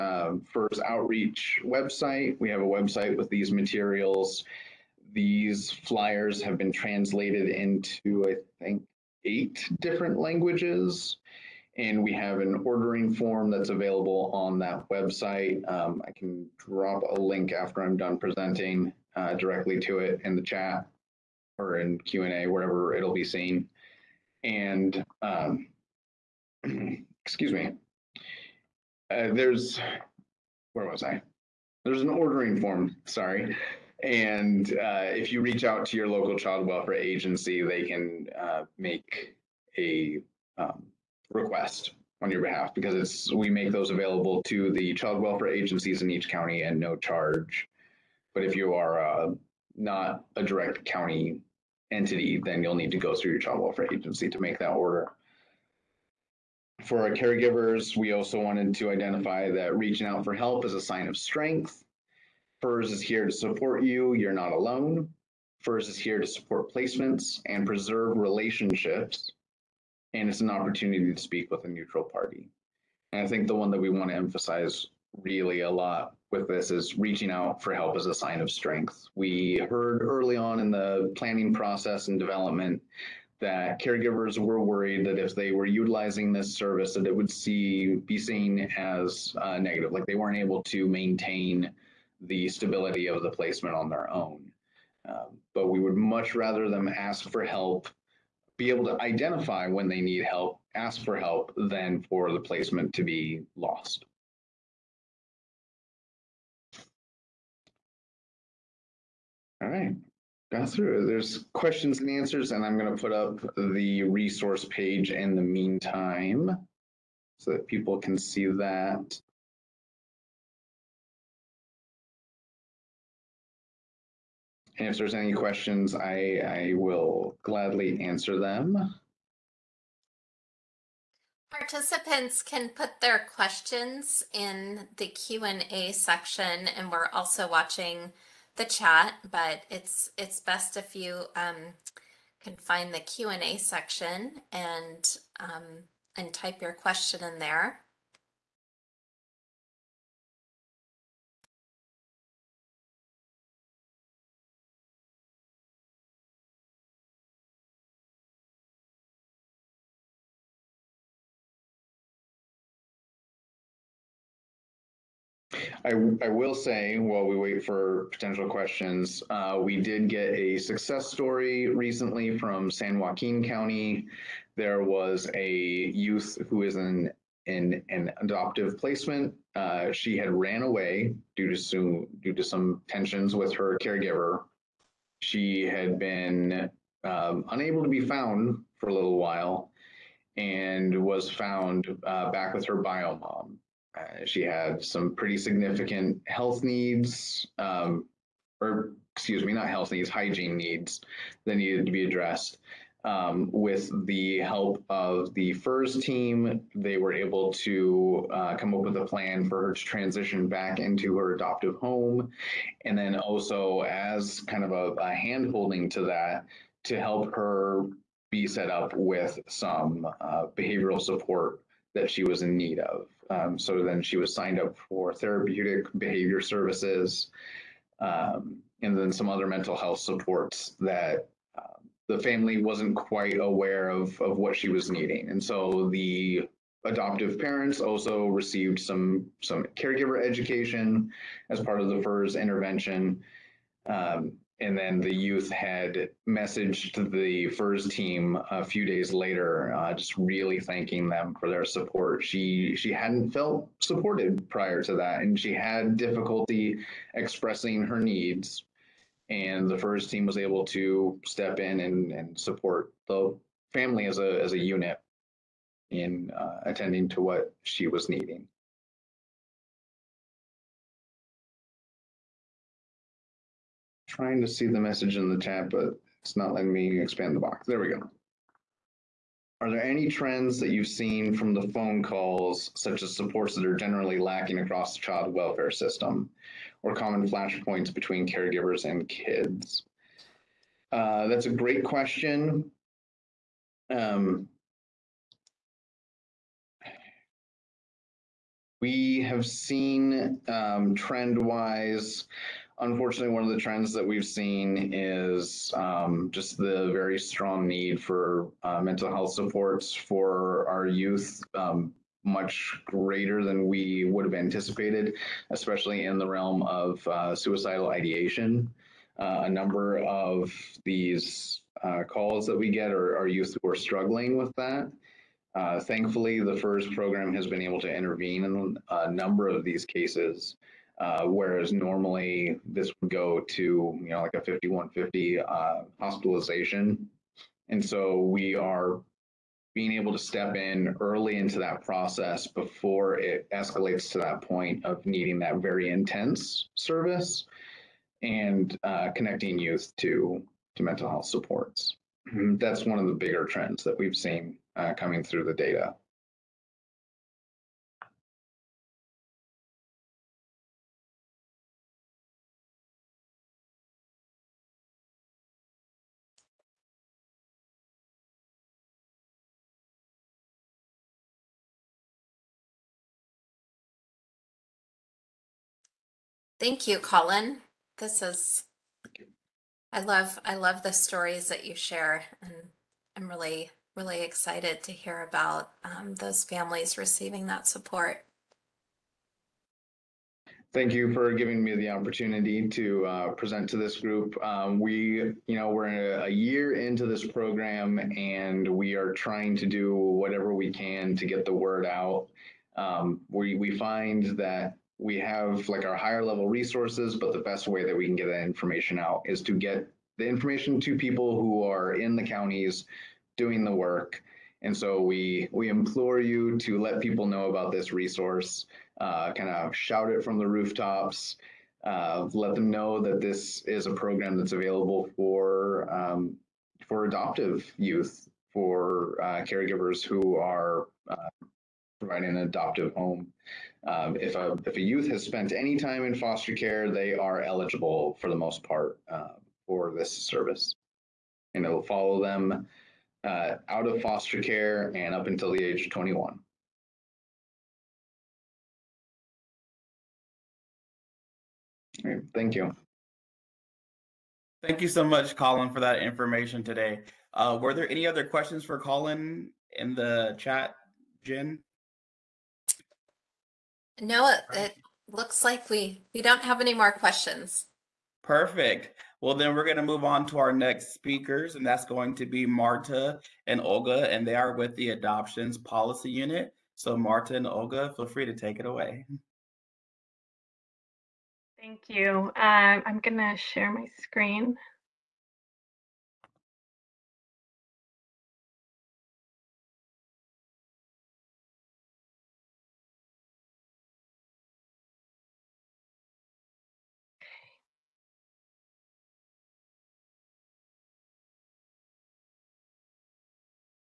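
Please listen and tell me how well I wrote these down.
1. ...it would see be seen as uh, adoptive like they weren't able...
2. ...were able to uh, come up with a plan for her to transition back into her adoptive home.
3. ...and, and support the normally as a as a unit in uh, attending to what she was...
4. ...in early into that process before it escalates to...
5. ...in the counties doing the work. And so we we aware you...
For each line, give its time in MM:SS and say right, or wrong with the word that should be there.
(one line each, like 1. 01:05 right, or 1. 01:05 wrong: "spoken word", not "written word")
1. 01:27 wrong: "negative", not "adoptive"
2. 03:26 right
3. 04:21 wrong: "family", not "normally"
4. 05:40 right
5. 06:51 wrong: "implore", not "aware".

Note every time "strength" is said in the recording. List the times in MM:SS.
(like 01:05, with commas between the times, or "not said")
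01:01, 01:18.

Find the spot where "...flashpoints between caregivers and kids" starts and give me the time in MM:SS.
04:47.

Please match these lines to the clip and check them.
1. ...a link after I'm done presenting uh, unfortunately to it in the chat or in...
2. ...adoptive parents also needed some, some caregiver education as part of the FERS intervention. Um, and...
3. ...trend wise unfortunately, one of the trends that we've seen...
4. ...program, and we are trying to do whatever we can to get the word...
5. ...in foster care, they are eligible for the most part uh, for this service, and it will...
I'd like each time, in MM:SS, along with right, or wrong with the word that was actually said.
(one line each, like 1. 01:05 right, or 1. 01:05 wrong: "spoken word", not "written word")
1. 00:17 wrong: "directly", not "unfortunately"
2. 03:56 wrong: "received", not "needed"
3. 05:00 right
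4. 06:37 right
5. 07:16 right.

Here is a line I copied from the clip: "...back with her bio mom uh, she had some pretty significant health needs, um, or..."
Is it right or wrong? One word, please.
right.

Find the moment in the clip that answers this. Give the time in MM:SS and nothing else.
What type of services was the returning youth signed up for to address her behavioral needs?
03:45.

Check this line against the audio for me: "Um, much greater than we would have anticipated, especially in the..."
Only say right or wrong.
right.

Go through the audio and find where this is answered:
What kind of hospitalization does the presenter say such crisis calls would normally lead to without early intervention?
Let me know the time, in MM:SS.
05:34.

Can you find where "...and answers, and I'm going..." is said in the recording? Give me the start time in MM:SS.
01:51.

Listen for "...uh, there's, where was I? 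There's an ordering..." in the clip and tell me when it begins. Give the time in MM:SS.
00:29.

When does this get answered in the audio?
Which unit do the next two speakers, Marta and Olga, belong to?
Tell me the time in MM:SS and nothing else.
07:54.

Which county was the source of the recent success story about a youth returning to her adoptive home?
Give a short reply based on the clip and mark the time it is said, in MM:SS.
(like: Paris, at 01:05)
San Joaquin County, at 02:52.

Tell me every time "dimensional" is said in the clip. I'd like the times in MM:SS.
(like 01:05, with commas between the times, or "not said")
not said.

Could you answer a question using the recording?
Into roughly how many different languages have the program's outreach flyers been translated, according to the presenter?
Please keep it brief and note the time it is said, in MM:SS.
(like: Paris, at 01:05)
8, at 00:09.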